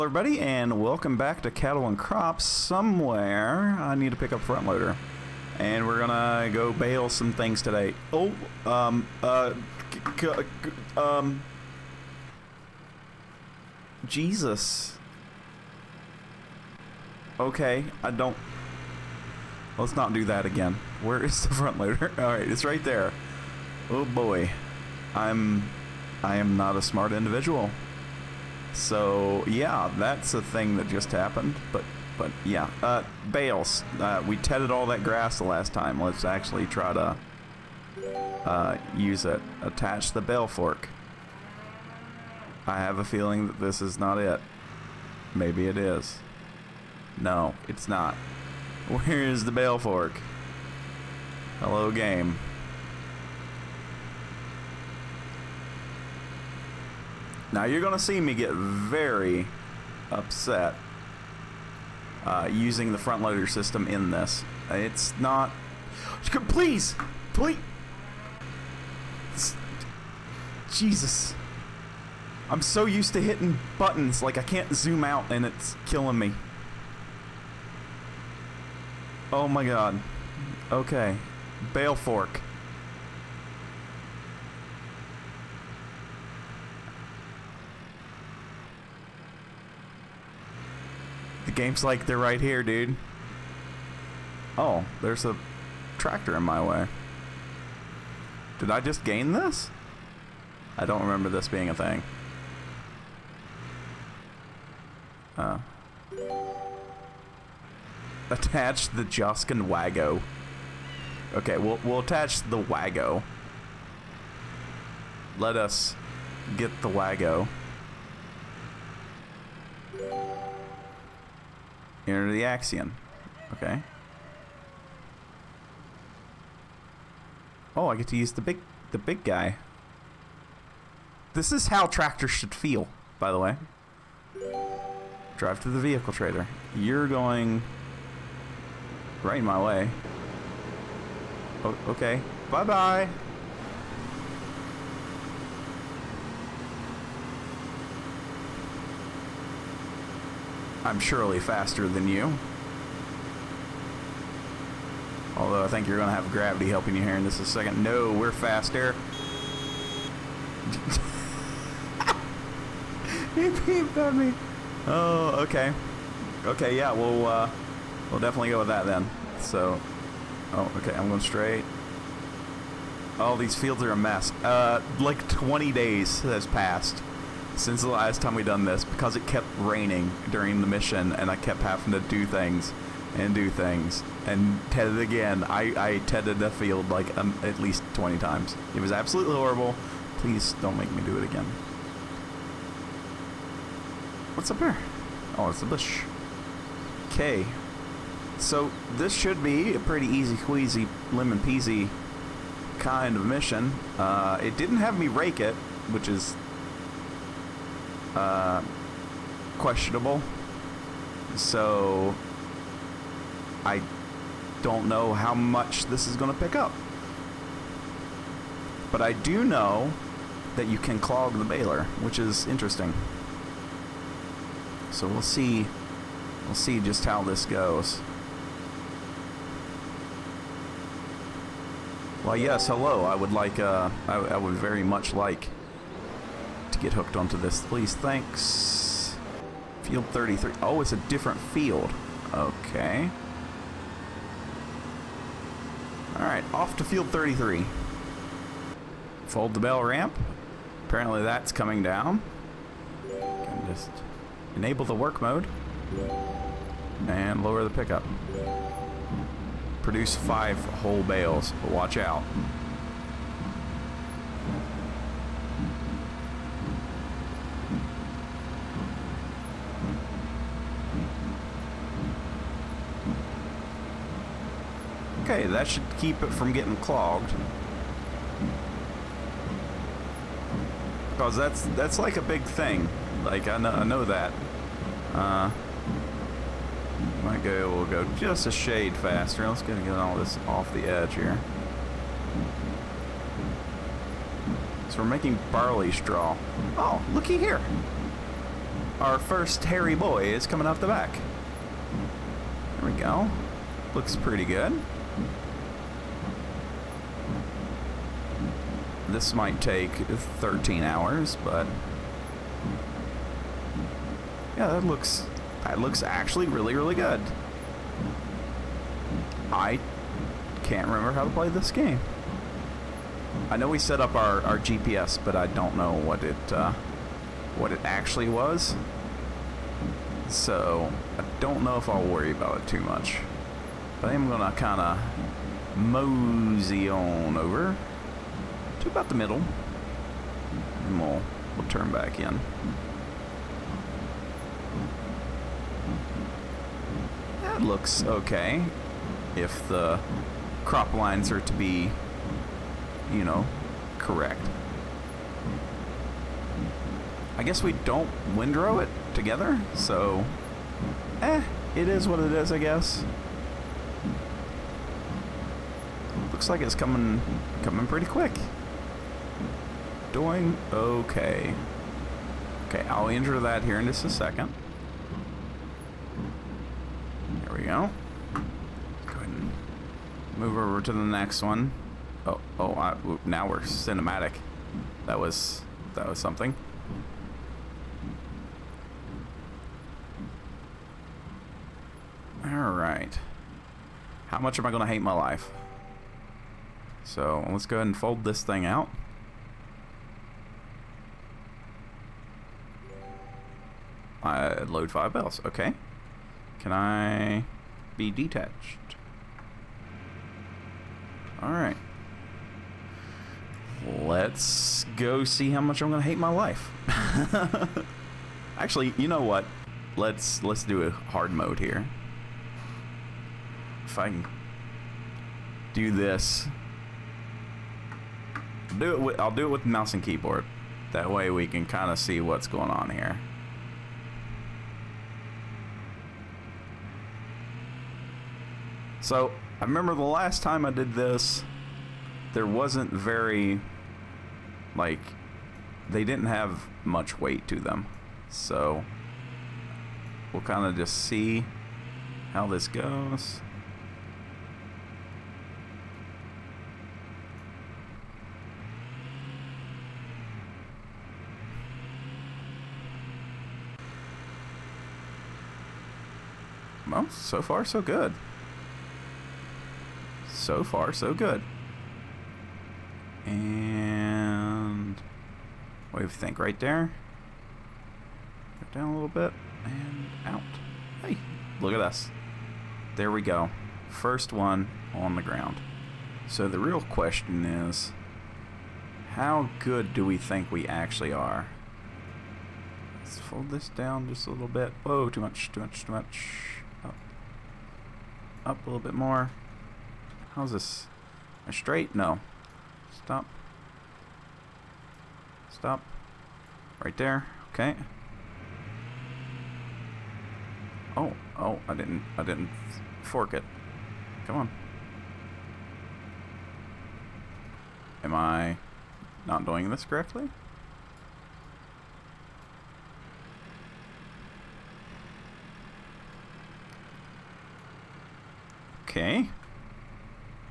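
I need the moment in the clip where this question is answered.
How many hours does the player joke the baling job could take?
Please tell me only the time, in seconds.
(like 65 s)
309 s.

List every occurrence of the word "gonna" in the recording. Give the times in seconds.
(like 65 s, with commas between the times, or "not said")
5 s, 334 s.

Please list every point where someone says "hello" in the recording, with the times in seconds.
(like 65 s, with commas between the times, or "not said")
51 s, 232 s.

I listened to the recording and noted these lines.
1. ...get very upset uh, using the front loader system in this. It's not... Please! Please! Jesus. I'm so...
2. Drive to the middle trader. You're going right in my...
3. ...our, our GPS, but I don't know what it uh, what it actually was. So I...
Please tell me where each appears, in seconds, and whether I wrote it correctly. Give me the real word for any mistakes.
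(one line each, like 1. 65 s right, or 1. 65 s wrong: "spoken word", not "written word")
1. 58 s right
2. 135 s wrong: "vehicle", not "middle"
3. 324 s right.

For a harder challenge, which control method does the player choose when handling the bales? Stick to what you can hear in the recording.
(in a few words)
mouse and keyboard.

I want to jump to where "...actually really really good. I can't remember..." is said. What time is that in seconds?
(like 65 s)
316 s.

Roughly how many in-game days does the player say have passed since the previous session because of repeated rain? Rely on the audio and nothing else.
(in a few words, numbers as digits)
20.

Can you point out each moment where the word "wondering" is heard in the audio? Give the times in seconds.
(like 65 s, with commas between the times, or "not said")
not said.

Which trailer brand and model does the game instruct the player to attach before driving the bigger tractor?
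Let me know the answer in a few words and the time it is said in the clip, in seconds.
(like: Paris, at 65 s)
Joskin Wago, at 109 s.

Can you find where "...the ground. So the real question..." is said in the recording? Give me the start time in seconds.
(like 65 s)
485 s.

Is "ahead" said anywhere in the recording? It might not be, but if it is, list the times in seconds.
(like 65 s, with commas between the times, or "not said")
379 s, 397 s.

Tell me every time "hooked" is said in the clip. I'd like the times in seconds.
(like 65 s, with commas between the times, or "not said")
236 s.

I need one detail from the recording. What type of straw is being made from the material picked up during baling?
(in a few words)
barley straw.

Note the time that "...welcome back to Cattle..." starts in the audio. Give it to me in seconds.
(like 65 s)
0 s.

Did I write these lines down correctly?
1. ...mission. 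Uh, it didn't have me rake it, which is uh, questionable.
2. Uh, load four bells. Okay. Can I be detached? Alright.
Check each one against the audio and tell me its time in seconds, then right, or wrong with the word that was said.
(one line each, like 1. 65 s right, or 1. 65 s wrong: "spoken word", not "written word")
1. 203 s right
2. 404 s wrong: "five", not "four".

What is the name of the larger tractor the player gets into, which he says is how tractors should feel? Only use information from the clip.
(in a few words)
Axion.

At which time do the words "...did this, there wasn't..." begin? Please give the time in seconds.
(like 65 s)
440 s.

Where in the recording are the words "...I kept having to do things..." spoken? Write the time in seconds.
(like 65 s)
181 s.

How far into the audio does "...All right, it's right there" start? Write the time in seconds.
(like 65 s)
22 s.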